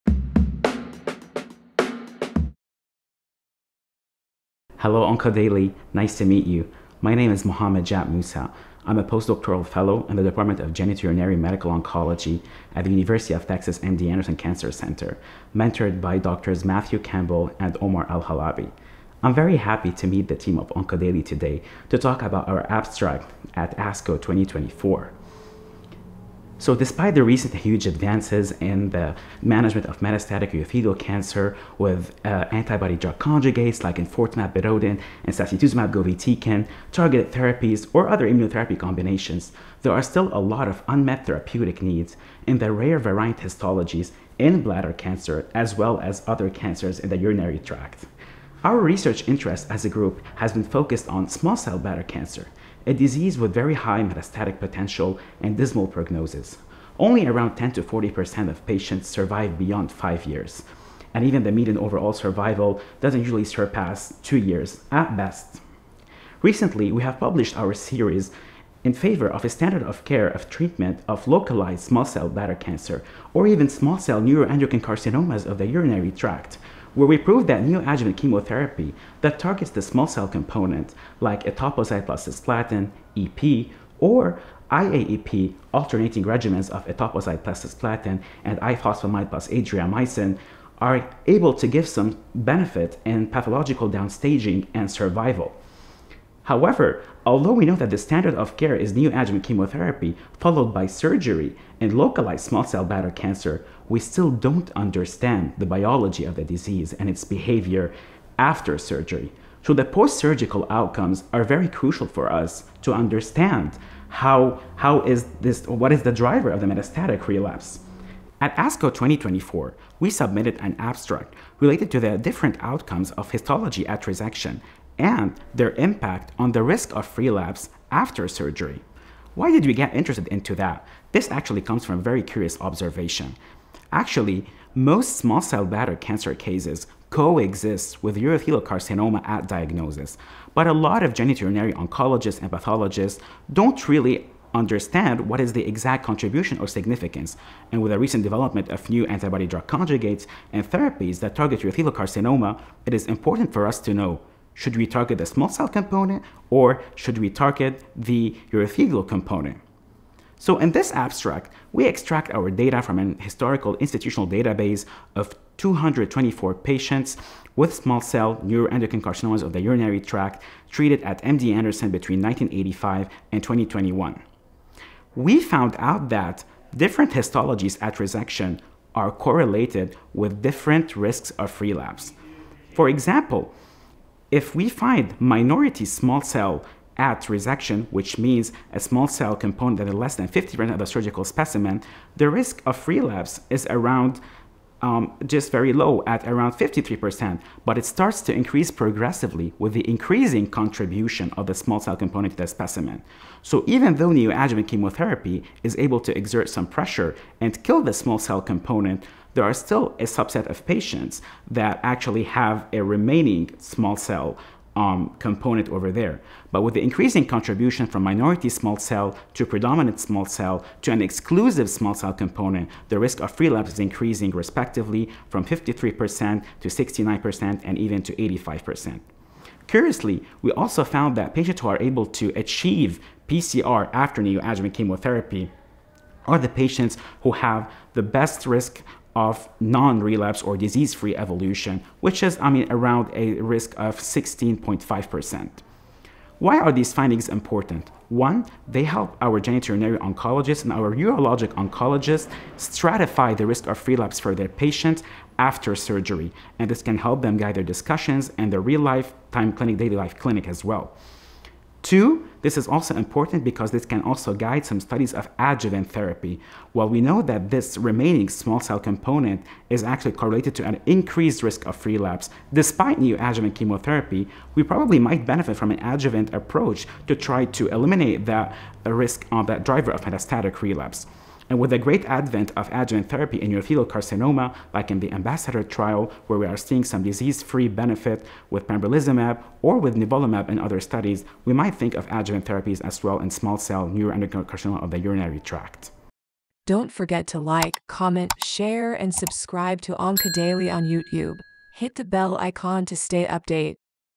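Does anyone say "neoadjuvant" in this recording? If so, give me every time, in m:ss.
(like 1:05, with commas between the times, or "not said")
1:17, 1:38, 3:24, 3:54, 4:32.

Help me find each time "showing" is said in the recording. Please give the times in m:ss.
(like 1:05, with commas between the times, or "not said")
not said.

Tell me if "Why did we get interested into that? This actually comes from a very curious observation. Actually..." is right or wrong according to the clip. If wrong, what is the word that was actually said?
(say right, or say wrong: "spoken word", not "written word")
right.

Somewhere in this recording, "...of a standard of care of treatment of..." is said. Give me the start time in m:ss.
1:09.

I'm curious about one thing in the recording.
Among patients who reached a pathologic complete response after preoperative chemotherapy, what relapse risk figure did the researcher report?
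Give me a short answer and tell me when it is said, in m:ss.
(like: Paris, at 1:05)
16.5%, at 4:03.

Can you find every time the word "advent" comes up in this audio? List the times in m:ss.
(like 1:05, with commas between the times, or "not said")
4:42.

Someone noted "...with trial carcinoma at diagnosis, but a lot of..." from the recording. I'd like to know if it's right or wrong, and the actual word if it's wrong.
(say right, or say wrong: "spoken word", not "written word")
wrong: "urothelial", not "trial".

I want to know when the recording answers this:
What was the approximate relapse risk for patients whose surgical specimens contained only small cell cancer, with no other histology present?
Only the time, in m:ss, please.
3:48.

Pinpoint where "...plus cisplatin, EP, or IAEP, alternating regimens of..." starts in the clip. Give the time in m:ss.
1:22.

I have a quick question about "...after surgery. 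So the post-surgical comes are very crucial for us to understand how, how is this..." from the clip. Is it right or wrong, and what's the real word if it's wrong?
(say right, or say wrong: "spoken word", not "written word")
wrong: "outcomes", not "comes".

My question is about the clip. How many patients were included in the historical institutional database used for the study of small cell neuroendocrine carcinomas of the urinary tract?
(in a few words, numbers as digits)
224.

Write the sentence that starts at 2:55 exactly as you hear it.
We found out that different histologies at resection are correlated with different risks of relapse.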